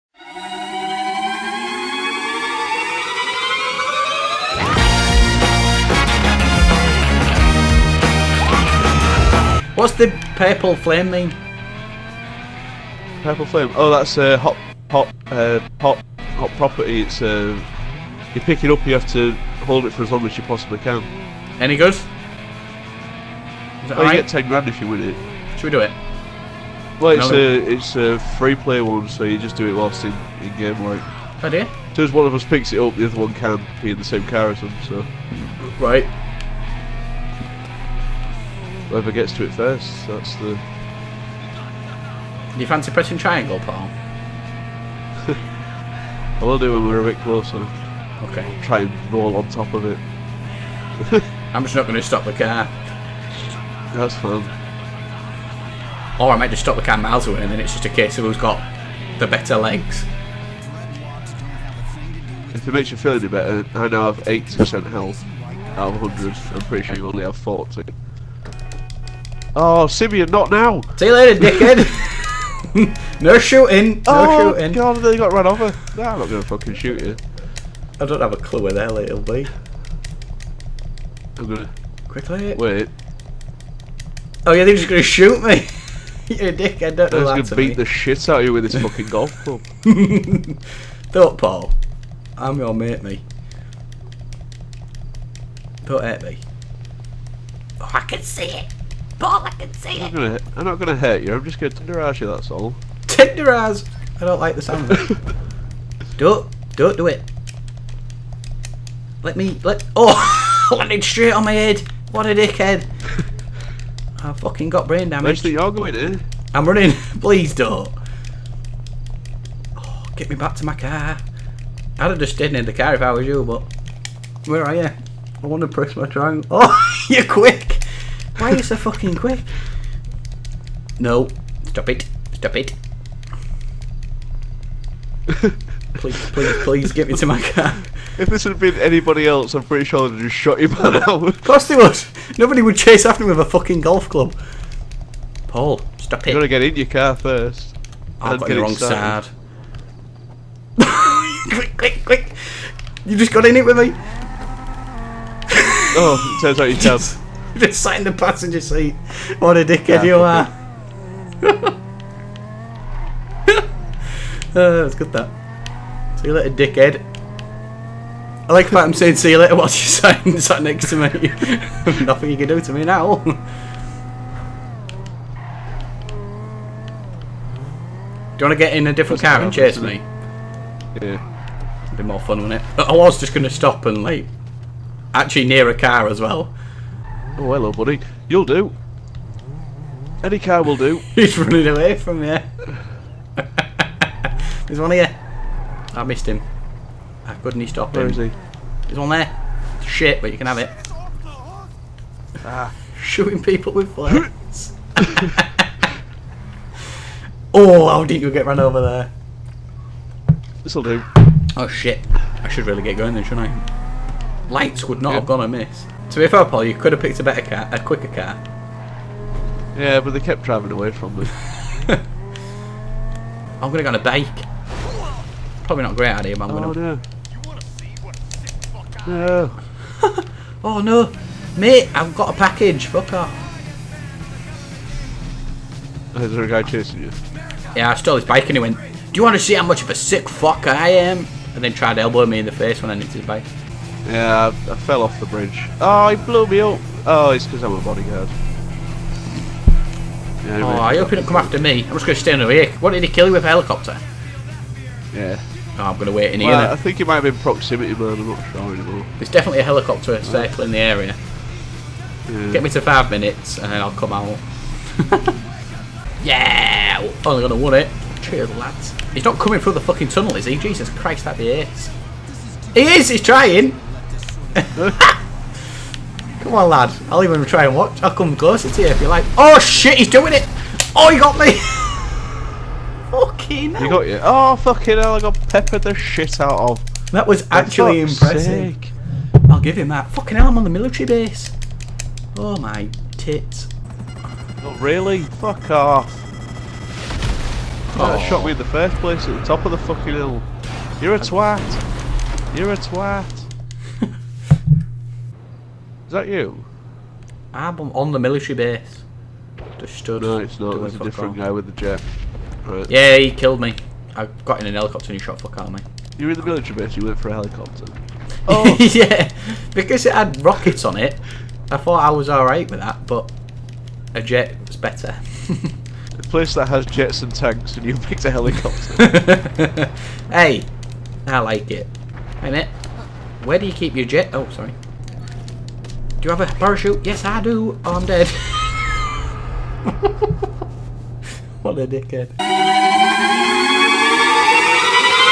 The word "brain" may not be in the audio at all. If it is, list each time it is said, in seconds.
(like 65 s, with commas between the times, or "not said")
114 s.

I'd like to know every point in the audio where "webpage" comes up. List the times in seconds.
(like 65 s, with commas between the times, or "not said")
not said.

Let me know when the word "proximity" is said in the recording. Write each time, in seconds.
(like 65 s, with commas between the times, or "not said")
257 s.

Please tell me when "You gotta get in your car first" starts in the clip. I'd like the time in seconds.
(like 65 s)
146 s.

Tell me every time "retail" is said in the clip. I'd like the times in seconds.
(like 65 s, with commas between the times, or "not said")
not said.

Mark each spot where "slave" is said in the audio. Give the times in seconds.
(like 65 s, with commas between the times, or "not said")
not said.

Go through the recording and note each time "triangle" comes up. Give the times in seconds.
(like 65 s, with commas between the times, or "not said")
43 s, 126 s.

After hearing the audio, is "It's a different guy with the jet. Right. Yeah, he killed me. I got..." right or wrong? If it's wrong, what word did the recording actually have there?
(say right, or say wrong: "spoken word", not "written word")
right.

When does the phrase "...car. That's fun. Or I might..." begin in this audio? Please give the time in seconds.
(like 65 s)
52 s.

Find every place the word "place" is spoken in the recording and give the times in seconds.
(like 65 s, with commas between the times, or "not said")
298 s, 326 s.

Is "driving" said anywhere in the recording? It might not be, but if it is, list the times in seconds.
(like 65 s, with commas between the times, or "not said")
220 s.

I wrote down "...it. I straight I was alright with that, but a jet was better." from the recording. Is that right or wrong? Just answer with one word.
wrong.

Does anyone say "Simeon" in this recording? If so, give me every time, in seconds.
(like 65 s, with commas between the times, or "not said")
69 s.